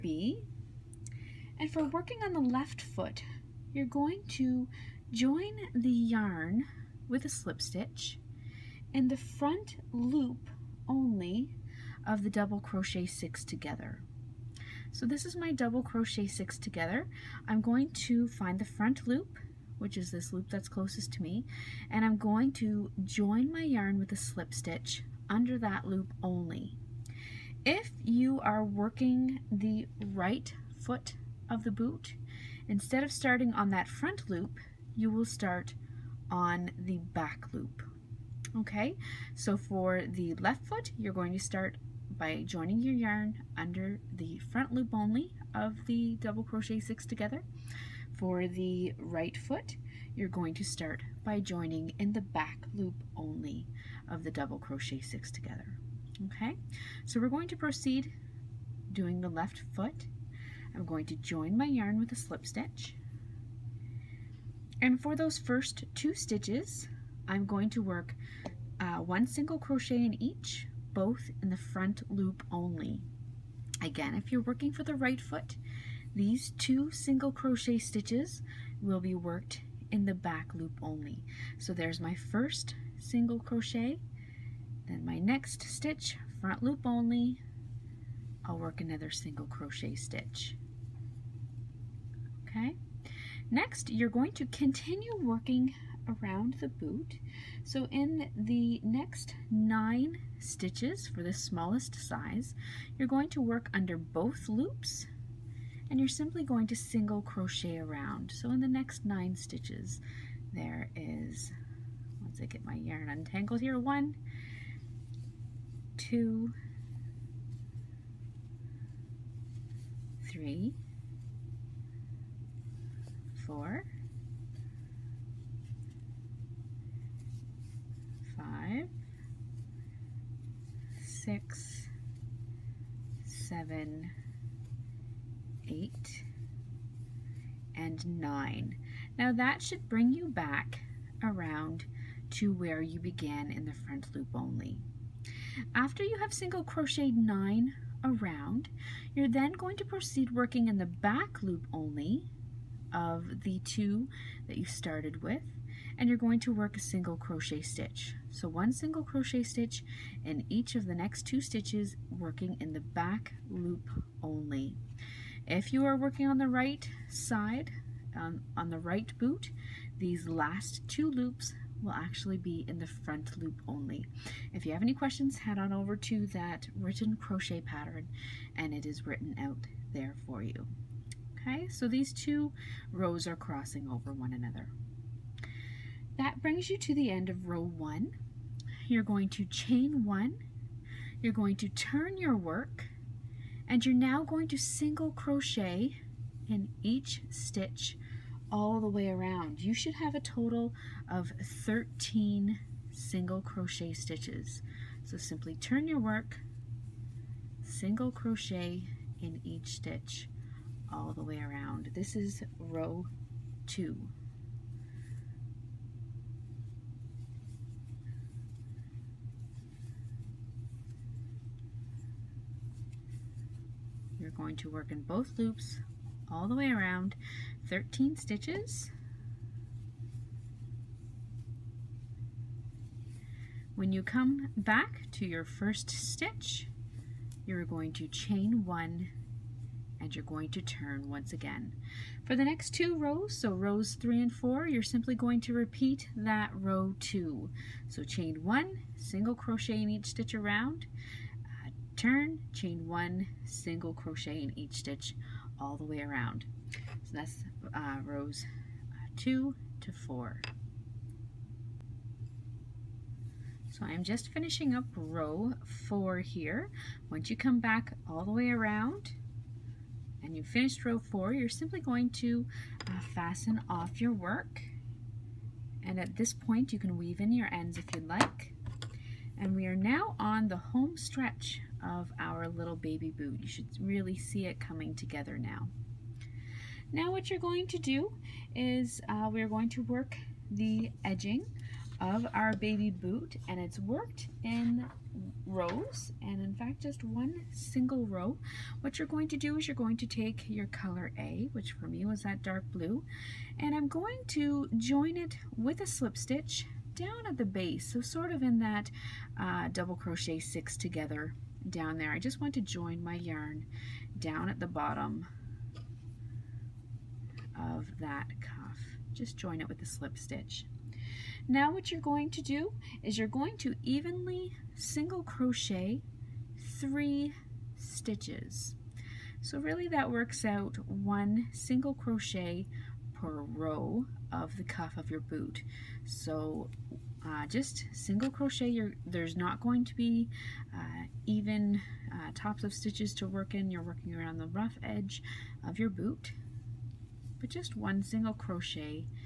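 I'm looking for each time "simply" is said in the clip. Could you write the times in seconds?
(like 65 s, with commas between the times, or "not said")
106 s, 205 s, 244 s, 271 s.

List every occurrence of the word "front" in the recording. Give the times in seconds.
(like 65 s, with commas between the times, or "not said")
9 s, 18 s, 33 s, 44 s, 71 s, 86 s, 143 s, 172 s.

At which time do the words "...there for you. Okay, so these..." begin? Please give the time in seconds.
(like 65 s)
179 s.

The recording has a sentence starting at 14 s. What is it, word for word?
So this is my double crochet six together.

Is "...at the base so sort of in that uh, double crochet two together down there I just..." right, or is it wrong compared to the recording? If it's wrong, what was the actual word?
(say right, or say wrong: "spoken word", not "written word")
wrong: "six", not "two".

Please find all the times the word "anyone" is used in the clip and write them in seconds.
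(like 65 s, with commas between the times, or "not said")
not said.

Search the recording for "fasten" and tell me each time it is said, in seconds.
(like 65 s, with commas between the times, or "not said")
273 s.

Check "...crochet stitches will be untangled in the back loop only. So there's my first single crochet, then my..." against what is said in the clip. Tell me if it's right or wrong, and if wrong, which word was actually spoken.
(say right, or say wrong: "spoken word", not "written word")
wrong: "worked", not "untangled".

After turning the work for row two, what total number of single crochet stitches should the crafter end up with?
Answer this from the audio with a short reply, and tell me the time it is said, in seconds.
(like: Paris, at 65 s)
13, at 201 s.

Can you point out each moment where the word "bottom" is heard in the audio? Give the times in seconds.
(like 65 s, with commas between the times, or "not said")
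314 s.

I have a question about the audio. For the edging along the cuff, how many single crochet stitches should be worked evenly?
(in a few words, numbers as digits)
3.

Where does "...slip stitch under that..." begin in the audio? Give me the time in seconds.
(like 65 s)
24 s.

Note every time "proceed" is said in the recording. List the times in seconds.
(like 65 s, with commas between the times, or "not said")
57 s, 149 s.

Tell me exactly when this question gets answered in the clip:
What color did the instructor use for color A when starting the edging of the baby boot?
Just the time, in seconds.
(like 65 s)
302 s.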